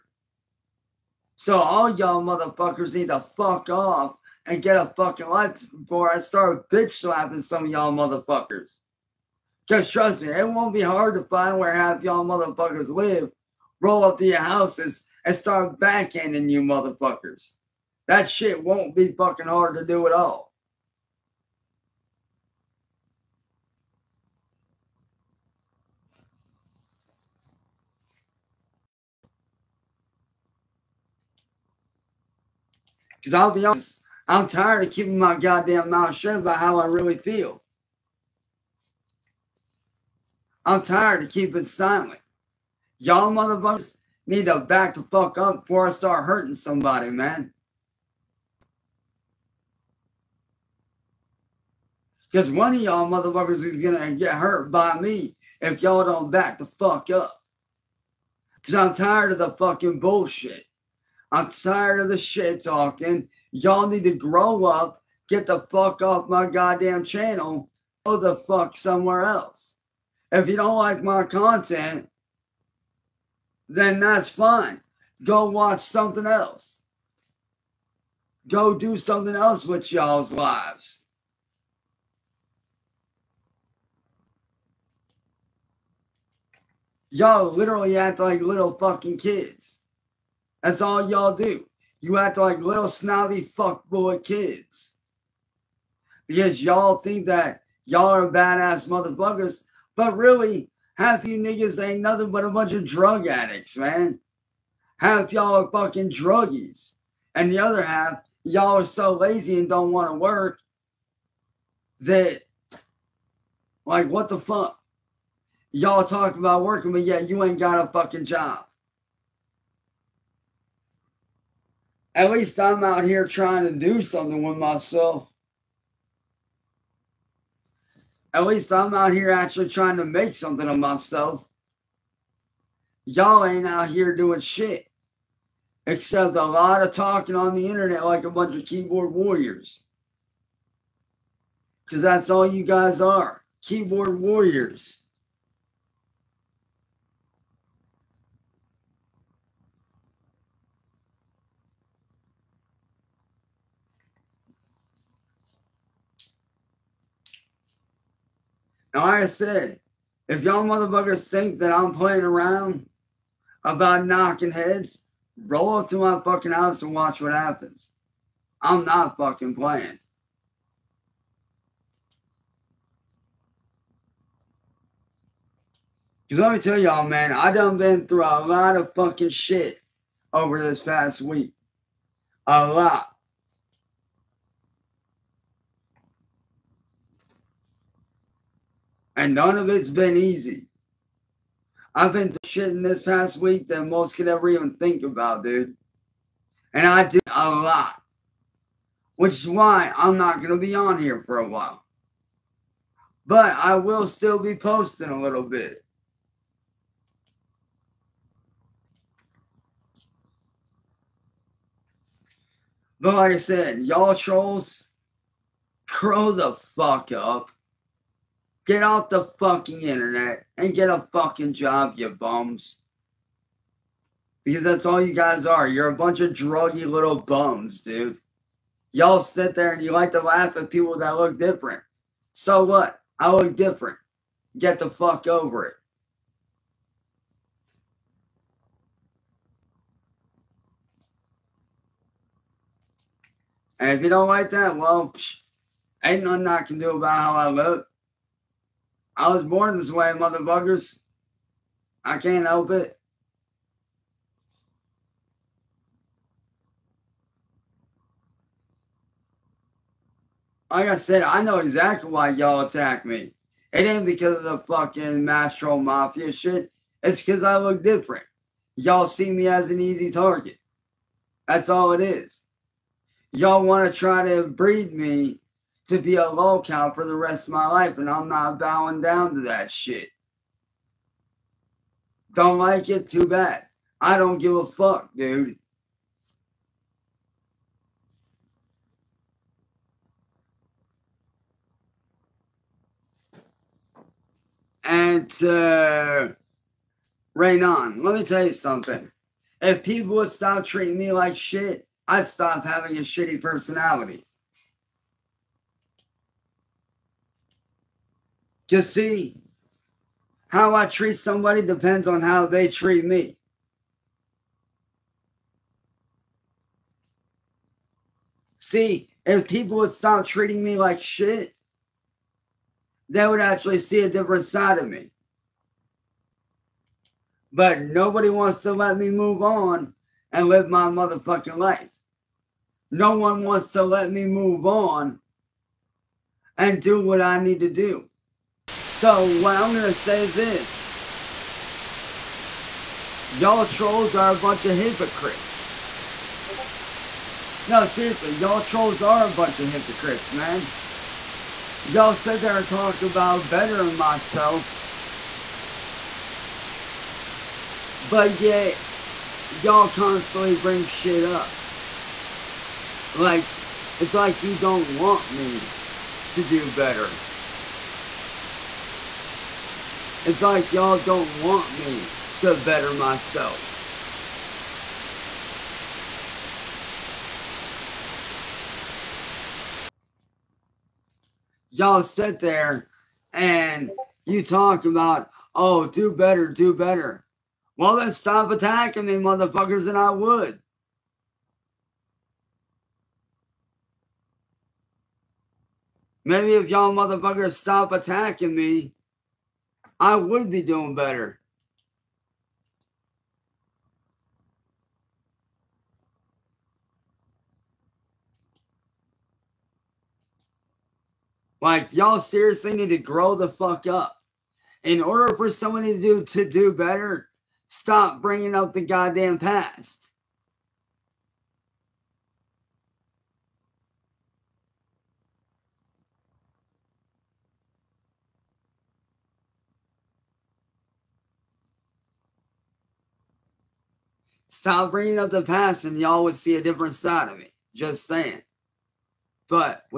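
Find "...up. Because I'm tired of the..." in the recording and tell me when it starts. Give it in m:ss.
0:57.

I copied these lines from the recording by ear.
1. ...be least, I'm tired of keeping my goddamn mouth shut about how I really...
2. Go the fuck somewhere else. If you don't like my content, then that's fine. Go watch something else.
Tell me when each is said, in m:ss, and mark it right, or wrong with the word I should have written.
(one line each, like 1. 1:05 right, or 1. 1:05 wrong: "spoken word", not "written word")
1. 0:33 wrong: "honest", not "least"
2. 1:08 right.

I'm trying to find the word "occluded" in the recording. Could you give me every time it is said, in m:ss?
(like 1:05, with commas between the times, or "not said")
not said.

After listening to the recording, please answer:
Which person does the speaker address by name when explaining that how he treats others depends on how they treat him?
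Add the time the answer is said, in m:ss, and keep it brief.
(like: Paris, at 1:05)
Raynon, at 4:57.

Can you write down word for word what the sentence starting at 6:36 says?
Maybe if y'all motherfuckers stop attacking me, I would be doing better.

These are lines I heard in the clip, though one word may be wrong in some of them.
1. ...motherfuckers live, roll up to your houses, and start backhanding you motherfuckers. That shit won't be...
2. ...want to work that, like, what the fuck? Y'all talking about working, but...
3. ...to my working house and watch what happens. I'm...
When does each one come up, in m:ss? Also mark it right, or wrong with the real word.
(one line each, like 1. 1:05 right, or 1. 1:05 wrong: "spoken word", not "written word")
1. 0:12 right
2. 1:49 right
3. 2:45 wrong: "fucking", not "working".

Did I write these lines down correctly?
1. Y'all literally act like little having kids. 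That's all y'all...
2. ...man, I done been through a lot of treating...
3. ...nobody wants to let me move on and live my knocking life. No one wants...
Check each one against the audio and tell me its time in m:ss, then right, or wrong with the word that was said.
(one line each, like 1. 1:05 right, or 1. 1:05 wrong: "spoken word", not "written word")
1. 1:27 wrong: "fucking", not "having"
2. 2:57 wrong: "fucking", not "treating"
3. 5:27 wrong: "motherfucking", not "knocking".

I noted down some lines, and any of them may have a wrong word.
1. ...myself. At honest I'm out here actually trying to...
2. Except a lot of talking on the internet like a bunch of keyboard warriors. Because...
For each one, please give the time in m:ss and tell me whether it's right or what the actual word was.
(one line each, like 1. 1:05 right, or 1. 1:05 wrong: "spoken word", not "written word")
1. 2:04 wrong: "least", not "honest"
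2. 2:15 right.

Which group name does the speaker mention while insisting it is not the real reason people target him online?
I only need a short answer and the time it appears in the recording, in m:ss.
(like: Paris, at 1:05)
Mastro Mafia, at 4:25.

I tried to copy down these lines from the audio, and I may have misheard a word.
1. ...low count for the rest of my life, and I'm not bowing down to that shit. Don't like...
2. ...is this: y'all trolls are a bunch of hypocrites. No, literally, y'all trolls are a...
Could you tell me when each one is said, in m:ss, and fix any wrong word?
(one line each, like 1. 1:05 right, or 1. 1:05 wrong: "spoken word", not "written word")
1. 4:36 right
2. 5:40 wrong: "seriously", not "literally".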